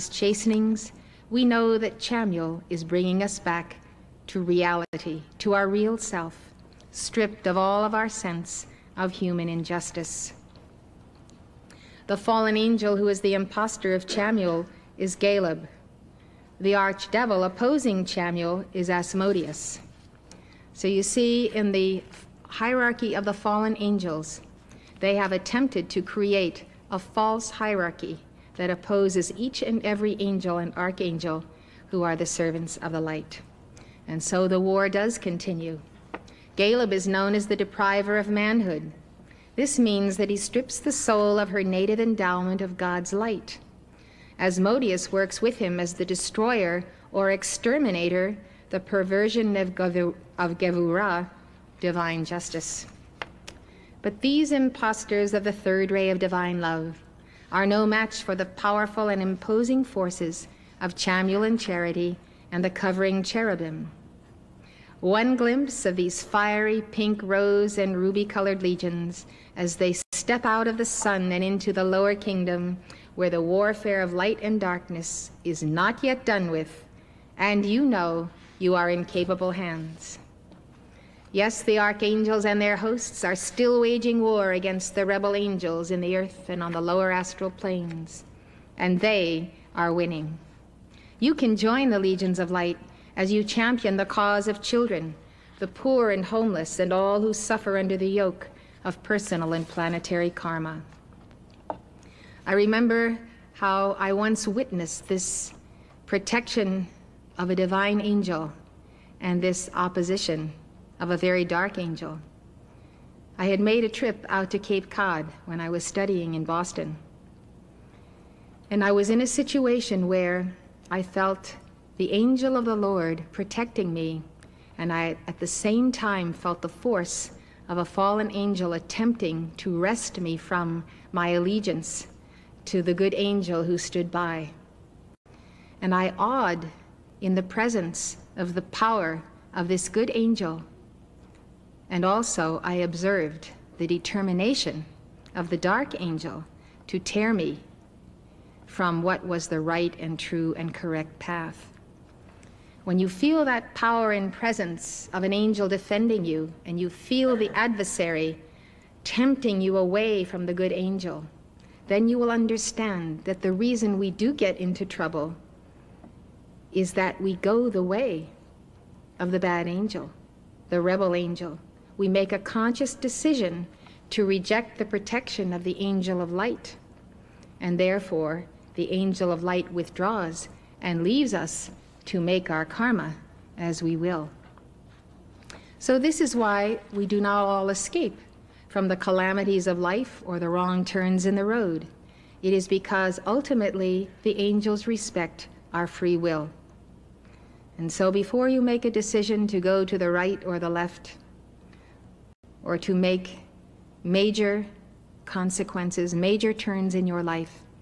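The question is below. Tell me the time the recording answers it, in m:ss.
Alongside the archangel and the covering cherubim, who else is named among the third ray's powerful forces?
1:01.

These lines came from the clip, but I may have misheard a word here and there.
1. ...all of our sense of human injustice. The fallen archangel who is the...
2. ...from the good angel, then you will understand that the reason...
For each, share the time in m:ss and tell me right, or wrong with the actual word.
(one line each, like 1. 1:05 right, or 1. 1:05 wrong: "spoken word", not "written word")
1. 0:07 wrong: "angel", not "archangel"
2. 2:40 right.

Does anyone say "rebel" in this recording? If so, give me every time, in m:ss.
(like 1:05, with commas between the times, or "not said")
1:25, 2:50.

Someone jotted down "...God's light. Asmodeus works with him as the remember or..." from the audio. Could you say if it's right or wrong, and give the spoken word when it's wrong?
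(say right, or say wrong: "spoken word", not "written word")
wrong: "destroyer", not "remember".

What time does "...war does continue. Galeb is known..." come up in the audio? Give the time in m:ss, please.
0:34.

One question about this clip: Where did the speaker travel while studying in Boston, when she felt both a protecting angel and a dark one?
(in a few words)
Cape Cod.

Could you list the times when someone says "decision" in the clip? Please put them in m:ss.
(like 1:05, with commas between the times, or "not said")
2:52, 3:18.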